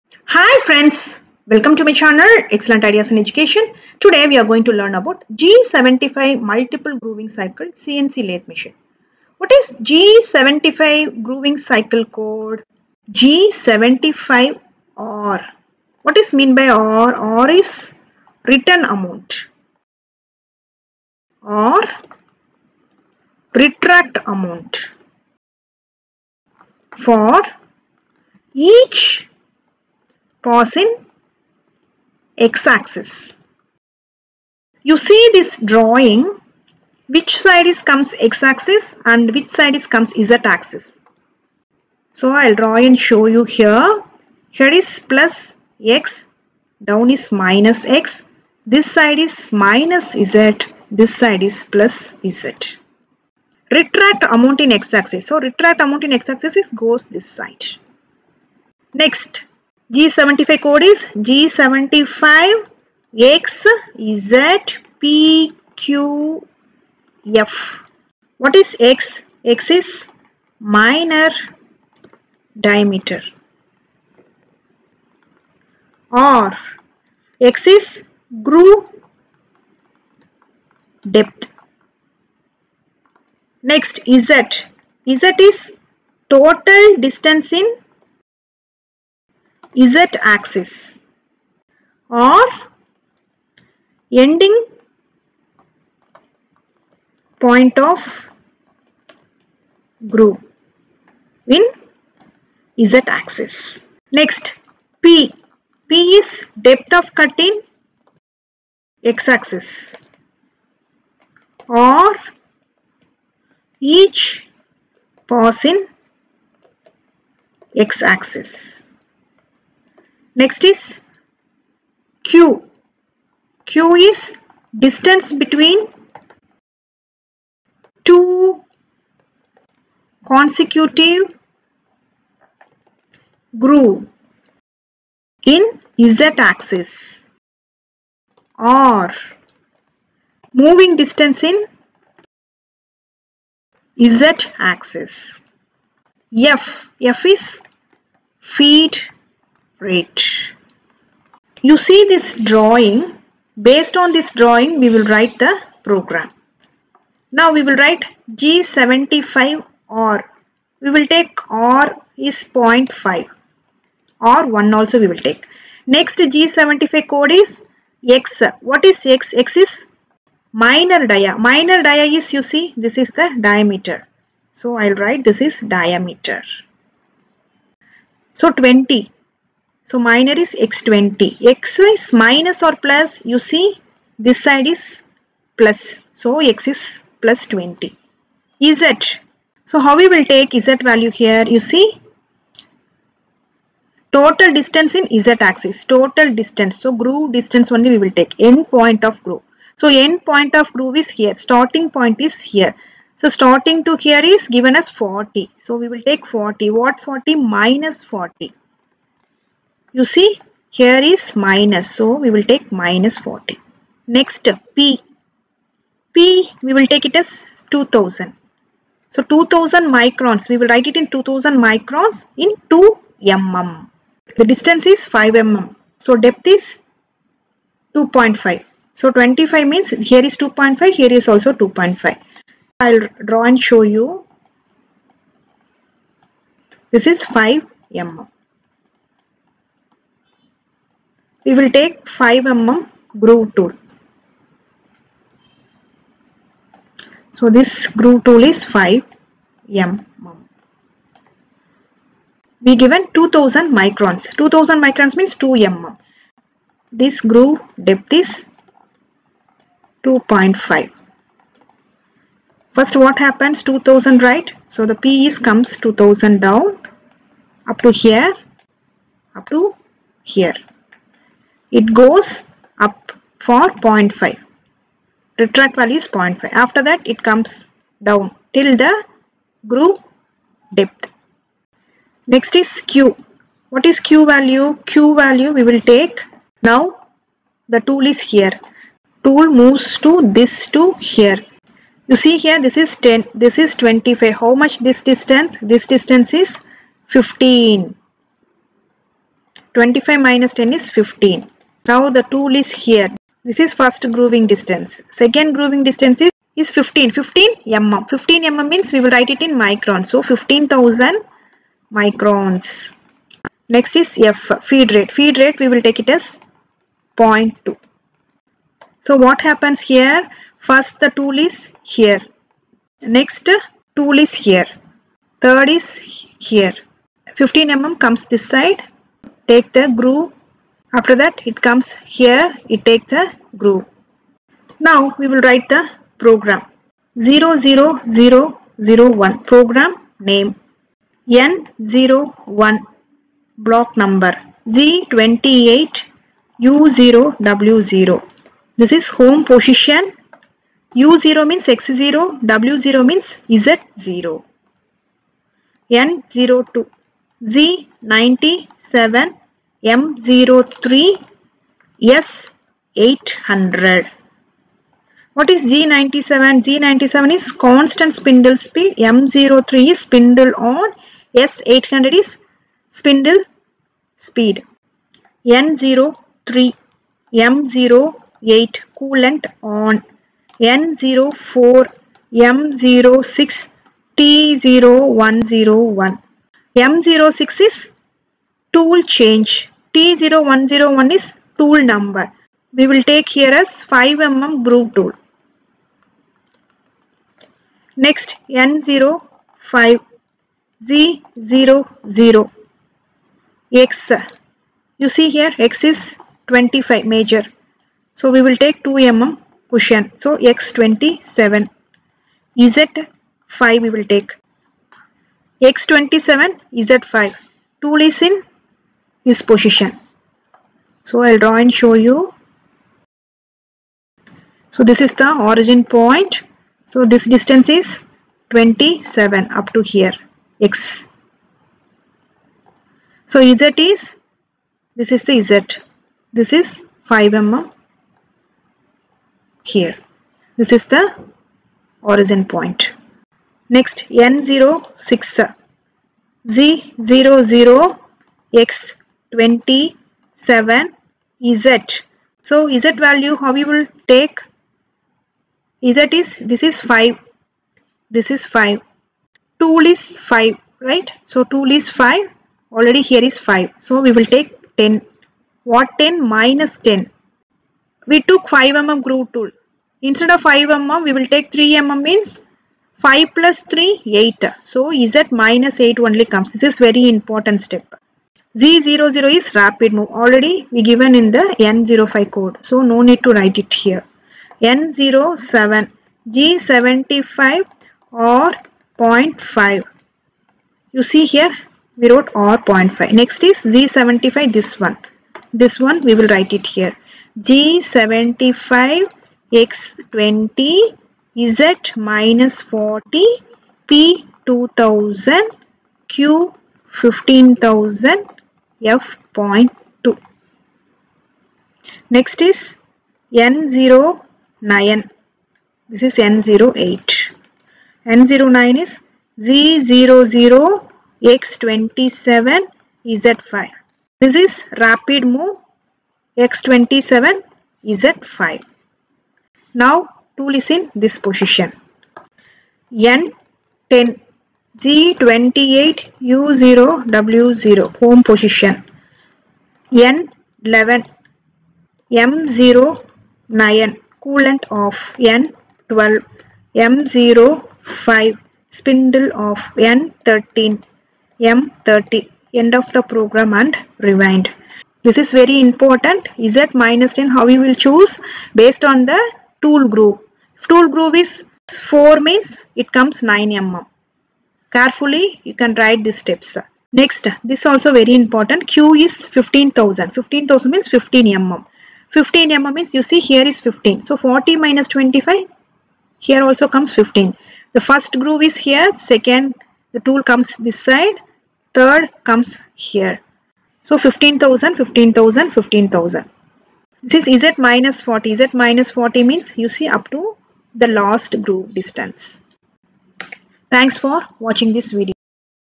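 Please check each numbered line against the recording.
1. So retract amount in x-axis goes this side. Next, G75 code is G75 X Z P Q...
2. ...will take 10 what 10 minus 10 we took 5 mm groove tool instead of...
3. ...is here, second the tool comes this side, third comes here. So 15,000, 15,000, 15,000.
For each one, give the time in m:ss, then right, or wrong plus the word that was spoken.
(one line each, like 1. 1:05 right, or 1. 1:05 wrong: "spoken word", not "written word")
1. 0:55 right
2. 7:44 right
3. 9:38 right.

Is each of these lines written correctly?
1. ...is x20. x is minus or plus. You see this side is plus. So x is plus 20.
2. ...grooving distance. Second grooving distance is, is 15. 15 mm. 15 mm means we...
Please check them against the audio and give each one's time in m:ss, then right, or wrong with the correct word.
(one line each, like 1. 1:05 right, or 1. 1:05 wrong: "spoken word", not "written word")
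1. 3:00 right
2. 5:04 right.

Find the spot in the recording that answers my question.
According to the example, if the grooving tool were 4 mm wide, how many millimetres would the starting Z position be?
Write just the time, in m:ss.
9:22.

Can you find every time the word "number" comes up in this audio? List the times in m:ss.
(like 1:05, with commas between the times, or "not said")
5:44, 6:31.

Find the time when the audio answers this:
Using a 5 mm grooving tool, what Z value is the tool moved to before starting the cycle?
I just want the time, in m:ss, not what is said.
7:55.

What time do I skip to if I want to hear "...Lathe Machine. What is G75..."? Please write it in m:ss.
0:08.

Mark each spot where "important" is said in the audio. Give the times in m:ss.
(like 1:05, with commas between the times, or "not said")
7:57, 9:15, 9:28.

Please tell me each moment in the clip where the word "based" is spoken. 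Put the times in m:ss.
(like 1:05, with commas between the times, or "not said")
2:33, 9:18.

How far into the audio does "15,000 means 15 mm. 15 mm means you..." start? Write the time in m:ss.
9:30.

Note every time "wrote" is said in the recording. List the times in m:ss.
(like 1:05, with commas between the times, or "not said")
8:12.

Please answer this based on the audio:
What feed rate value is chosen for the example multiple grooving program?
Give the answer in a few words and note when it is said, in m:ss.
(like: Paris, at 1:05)
0.2, at 5:15.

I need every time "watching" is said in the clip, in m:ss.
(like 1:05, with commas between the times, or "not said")
9:54.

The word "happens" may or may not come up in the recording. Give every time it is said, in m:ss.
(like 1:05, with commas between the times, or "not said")
4:23, 5:19.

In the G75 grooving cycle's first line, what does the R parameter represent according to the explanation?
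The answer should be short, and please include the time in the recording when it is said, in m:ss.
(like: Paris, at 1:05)
Retract amount for each pause in x-axis, at 0:17.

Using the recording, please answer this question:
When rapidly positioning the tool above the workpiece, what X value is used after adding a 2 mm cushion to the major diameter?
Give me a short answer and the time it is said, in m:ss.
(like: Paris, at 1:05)
27, at 6:50.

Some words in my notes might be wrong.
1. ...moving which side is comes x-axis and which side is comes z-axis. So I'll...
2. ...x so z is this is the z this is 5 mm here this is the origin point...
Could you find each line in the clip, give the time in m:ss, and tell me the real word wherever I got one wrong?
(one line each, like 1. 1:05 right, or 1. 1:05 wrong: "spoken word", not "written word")
1. 0:35 wrong: "drawing", not "moving"
2. 7:10 right.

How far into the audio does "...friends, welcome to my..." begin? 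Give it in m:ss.
0:00.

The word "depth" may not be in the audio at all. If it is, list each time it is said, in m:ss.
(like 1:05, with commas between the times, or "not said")
1:21, 1:46, 3:46, 4:17, 4:40.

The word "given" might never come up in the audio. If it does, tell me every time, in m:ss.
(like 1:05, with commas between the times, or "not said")
3:24, 4:12, 8:00.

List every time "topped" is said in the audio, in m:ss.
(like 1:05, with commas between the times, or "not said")
not said.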